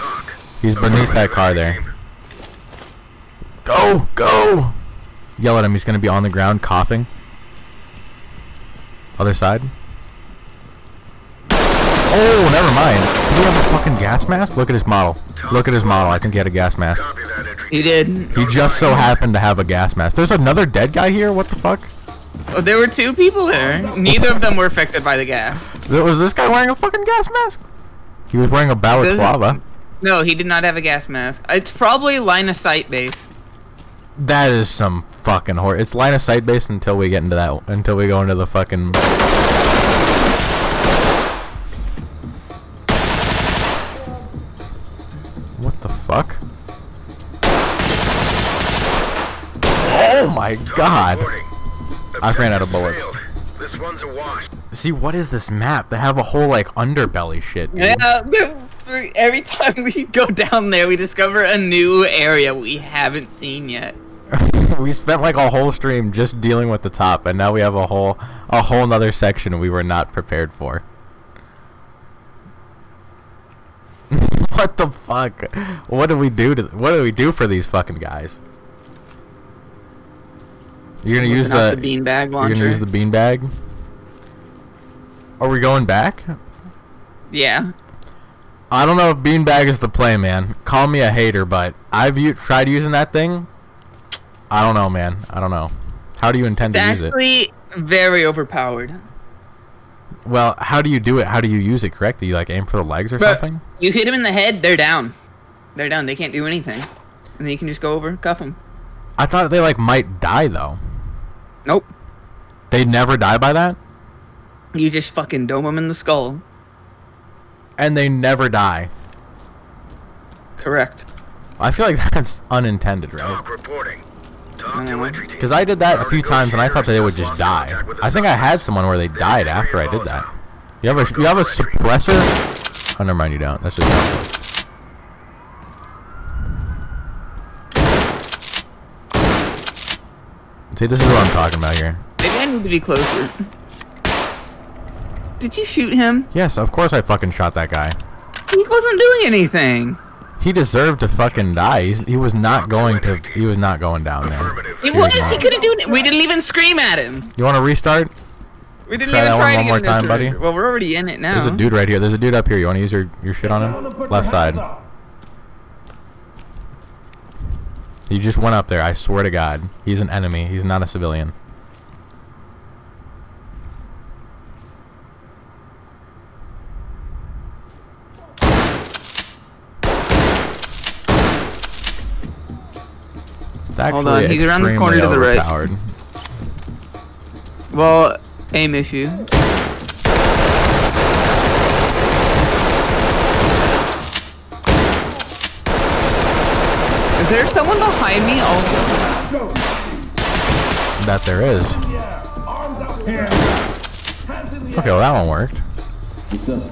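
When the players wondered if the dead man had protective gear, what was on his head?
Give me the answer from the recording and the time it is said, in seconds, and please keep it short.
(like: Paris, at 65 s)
Balaclava, at 28 s.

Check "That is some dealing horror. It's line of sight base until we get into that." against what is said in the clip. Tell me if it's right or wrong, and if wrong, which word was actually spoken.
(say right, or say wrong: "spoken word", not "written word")
wrong: "fucking", not "dealing".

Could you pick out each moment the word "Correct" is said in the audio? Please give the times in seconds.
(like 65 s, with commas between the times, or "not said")
101 s, 120 s.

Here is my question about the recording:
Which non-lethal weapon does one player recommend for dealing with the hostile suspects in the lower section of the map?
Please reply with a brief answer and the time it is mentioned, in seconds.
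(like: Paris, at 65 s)
Beanbag launcher, at 81 s.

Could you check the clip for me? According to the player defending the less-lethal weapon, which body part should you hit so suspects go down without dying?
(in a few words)
The head.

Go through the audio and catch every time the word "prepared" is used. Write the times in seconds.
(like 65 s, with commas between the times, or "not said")
70 s.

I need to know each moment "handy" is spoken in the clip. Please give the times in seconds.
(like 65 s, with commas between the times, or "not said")
not said.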